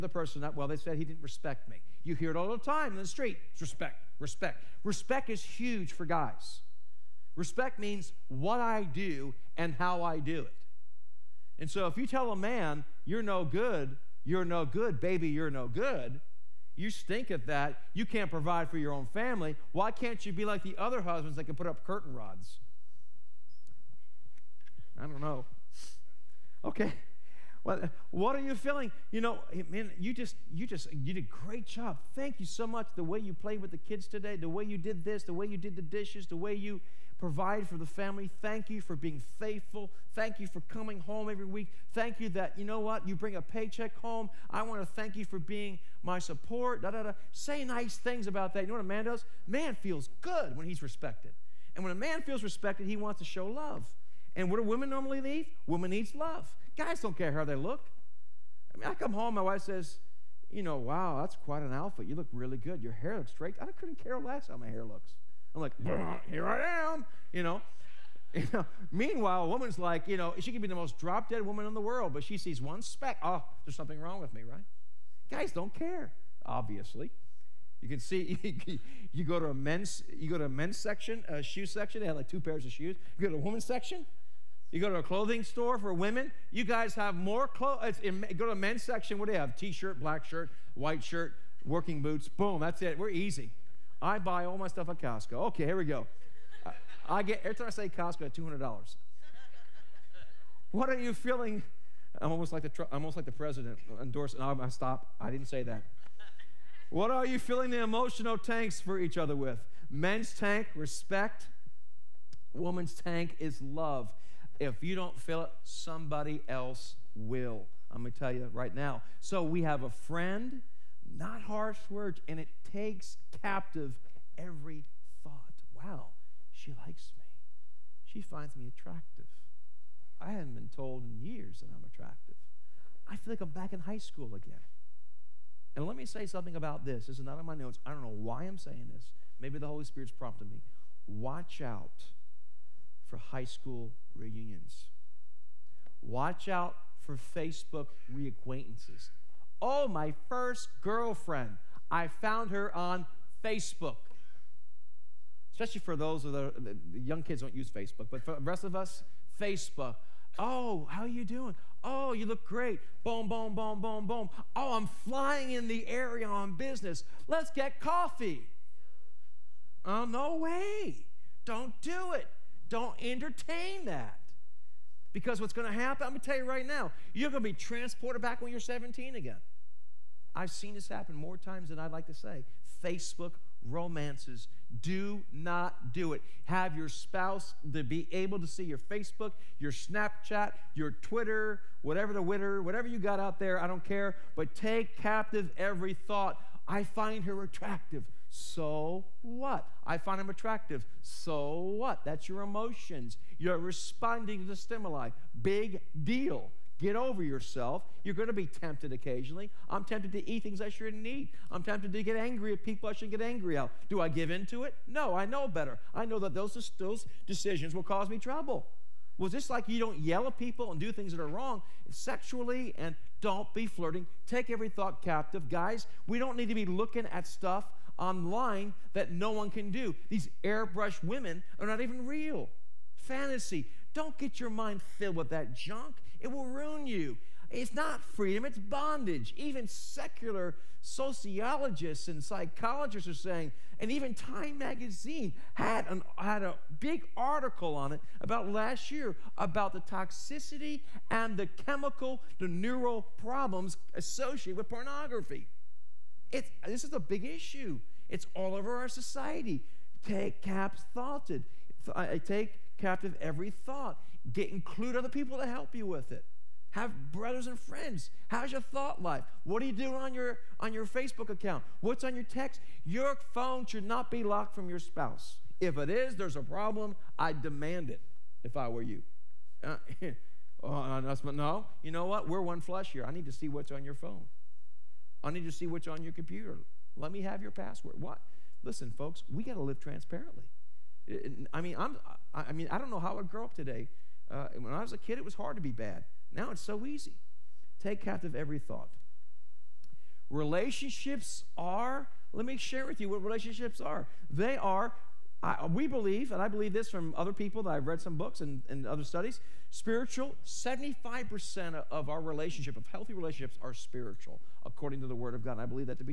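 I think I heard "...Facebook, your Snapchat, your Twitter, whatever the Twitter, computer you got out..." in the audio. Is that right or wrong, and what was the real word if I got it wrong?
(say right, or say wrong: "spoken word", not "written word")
wrong: "whatever", not "computer".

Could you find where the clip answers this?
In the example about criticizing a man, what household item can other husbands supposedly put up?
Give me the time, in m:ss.
0:21.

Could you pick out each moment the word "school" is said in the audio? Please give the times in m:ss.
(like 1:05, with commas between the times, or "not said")
2:13, 2:23.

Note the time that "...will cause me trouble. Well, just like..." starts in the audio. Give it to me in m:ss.
3:37.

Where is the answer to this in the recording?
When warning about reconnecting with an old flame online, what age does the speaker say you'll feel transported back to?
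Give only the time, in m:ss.
2:58.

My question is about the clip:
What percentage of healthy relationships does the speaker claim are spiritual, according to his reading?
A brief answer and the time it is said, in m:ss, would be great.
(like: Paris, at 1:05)
75%, at 5:10.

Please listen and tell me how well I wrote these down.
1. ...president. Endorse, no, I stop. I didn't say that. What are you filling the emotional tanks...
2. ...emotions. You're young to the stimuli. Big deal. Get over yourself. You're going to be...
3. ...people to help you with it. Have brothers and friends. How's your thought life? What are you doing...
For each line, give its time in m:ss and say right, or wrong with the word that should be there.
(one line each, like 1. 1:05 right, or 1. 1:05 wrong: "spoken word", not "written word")
1. 1:43 right
2. 3:22 wrong: "responding", not "young"
3. 4:25 right.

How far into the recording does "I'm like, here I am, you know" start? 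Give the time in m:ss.
1:05.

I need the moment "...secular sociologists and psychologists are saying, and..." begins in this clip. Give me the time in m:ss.
3:59.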